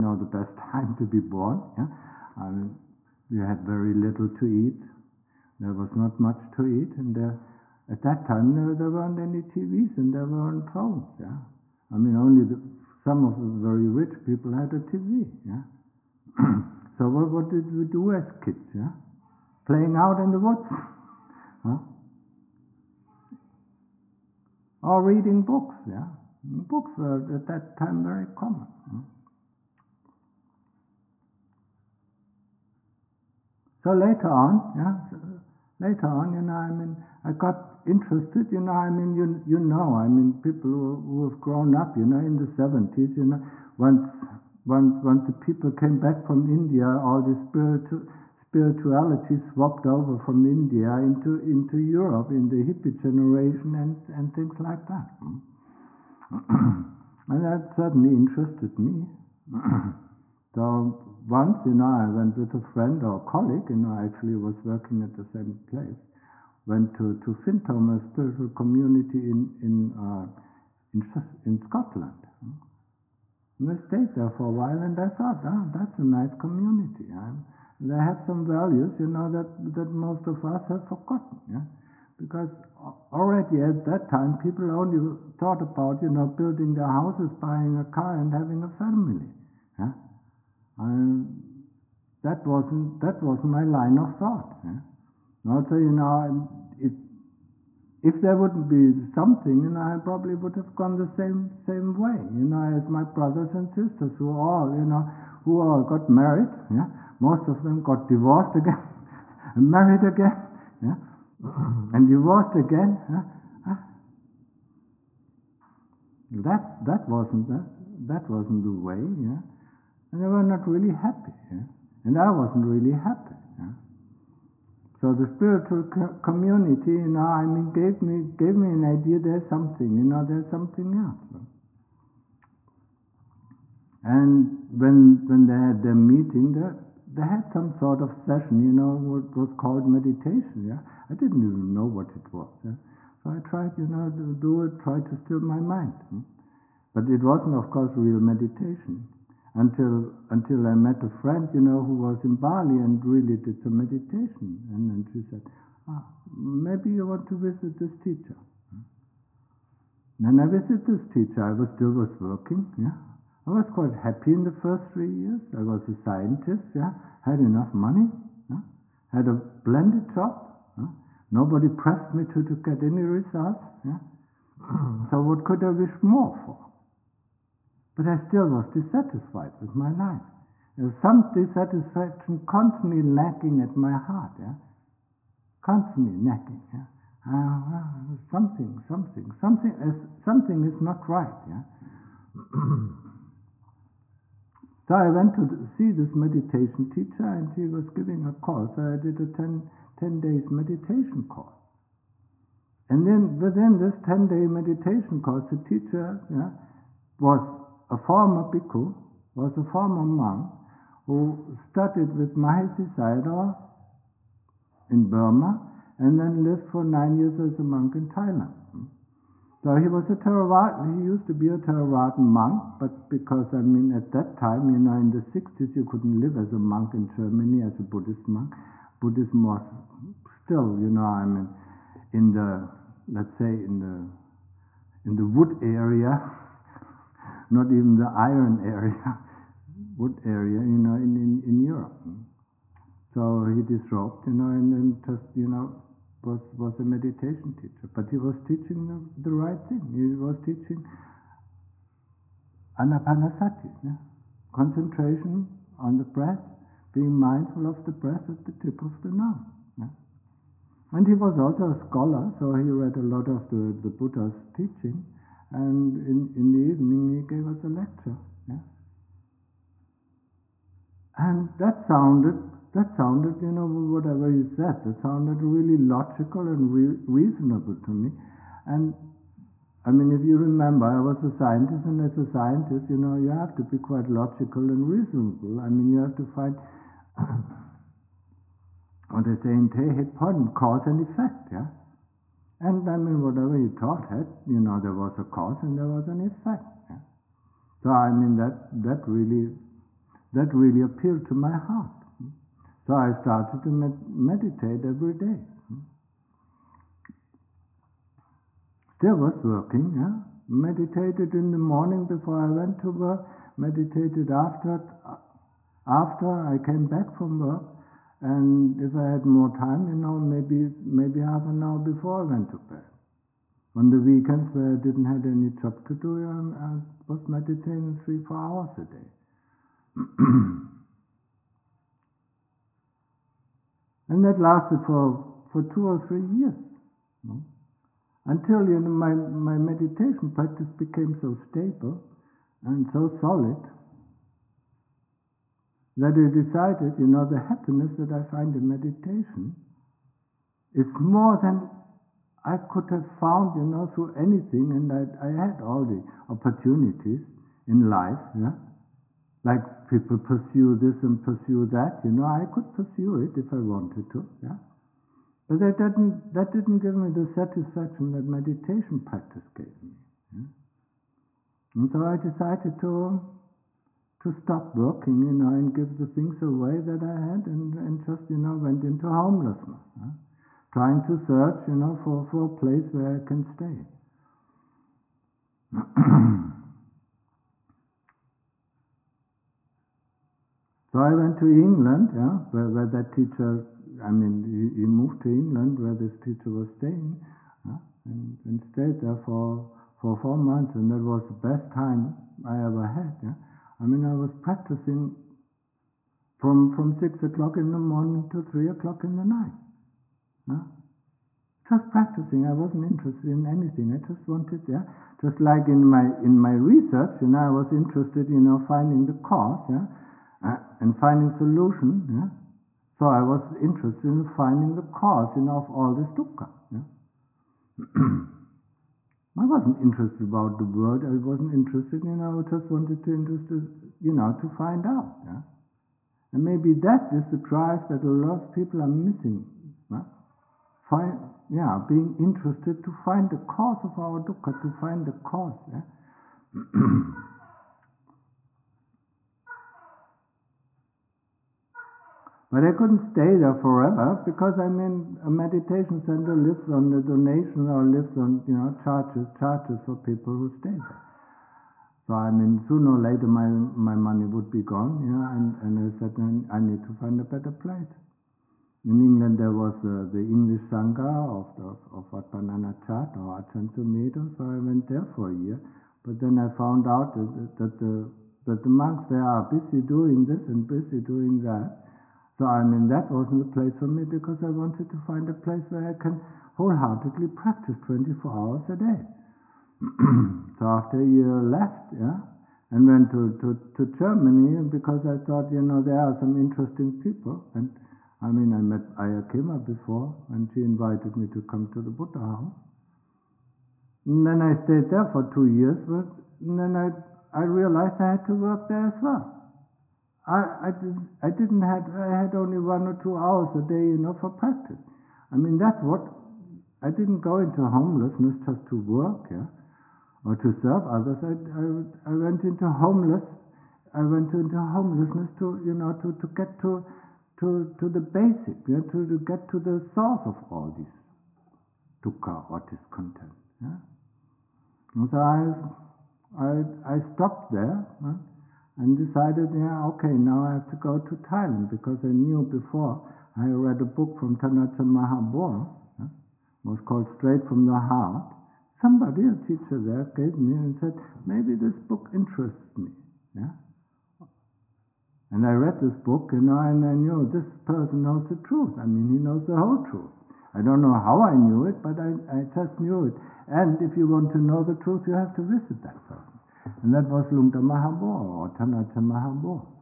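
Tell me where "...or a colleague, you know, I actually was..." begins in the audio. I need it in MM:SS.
01:03.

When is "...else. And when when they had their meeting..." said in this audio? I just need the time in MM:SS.
02:10.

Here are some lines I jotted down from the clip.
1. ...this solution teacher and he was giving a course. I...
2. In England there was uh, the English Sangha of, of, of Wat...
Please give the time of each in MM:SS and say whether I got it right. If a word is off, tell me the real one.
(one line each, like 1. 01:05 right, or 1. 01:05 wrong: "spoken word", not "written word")
1. 03:15 wrong: "meditation", not "solution"
2. 07:48 right.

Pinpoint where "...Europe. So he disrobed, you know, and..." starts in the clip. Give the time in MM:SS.
04:01.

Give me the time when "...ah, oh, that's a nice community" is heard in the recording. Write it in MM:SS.
01:15.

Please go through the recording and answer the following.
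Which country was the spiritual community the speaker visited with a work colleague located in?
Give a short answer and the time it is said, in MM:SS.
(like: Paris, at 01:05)
Scotland, at 01:11.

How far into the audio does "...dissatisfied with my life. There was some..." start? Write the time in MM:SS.
02:58.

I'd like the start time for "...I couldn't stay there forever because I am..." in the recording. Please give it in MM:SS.
07:32.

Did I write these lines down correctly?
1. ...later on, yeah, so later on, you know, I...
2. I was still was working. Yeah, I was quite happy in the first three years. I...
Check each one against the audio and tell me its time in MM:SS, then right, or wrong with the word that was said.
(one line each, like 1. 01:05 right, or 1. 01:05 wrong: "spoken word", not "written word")
1. 00:33 right
2. 02:41 right.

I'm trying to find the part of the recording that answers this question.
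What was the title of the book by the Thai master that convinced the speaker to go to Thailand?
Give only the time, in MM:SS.
09:07.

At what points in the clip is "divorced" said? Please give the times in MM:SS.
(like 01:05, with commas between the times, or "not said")
01:48, 01:52.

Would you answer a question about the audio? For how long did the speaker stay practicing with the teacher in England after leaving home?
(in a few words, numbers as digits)
4 months.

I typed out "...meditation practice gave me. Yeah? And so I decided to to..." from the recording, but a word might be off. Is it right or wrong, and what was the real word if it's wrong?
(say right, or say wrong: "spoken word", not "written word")
right.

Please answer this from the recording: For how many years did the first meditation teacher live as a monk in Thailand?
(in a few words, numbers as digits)
9.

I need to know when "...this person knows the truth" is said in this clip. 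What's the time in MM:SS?
09:17.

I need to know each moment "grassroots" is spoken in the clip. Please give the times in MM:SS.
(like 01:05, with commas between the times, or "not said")
not said.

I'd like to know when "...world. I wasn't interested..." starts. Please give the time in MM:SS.
07:10.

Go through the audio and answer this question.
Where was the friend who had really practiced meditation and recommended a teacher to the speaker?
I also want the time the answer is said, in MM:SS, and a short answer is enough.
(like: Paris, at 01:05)
Bali, at 02:32.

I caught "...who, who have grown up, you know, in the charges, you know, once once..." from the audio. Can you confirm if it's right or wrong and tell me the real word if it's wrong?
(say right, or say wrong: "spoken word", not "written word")
wrong: "seventies", not "charges".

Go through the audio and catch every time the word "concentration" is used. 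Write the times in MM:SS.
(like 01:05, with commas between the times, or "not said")
04:14.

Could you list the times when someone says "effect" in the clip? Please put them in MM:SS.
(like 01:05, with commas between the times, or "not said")
04:50, 04:56.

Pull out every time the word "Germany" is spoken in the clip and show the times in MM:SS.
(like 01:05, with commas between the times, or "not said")
03:47, 08:13.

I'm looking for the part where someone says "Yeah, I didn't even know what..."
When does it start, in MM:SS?
02:20.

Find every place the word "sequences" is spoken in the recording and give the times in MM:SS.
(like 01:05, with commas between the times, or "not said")
not said.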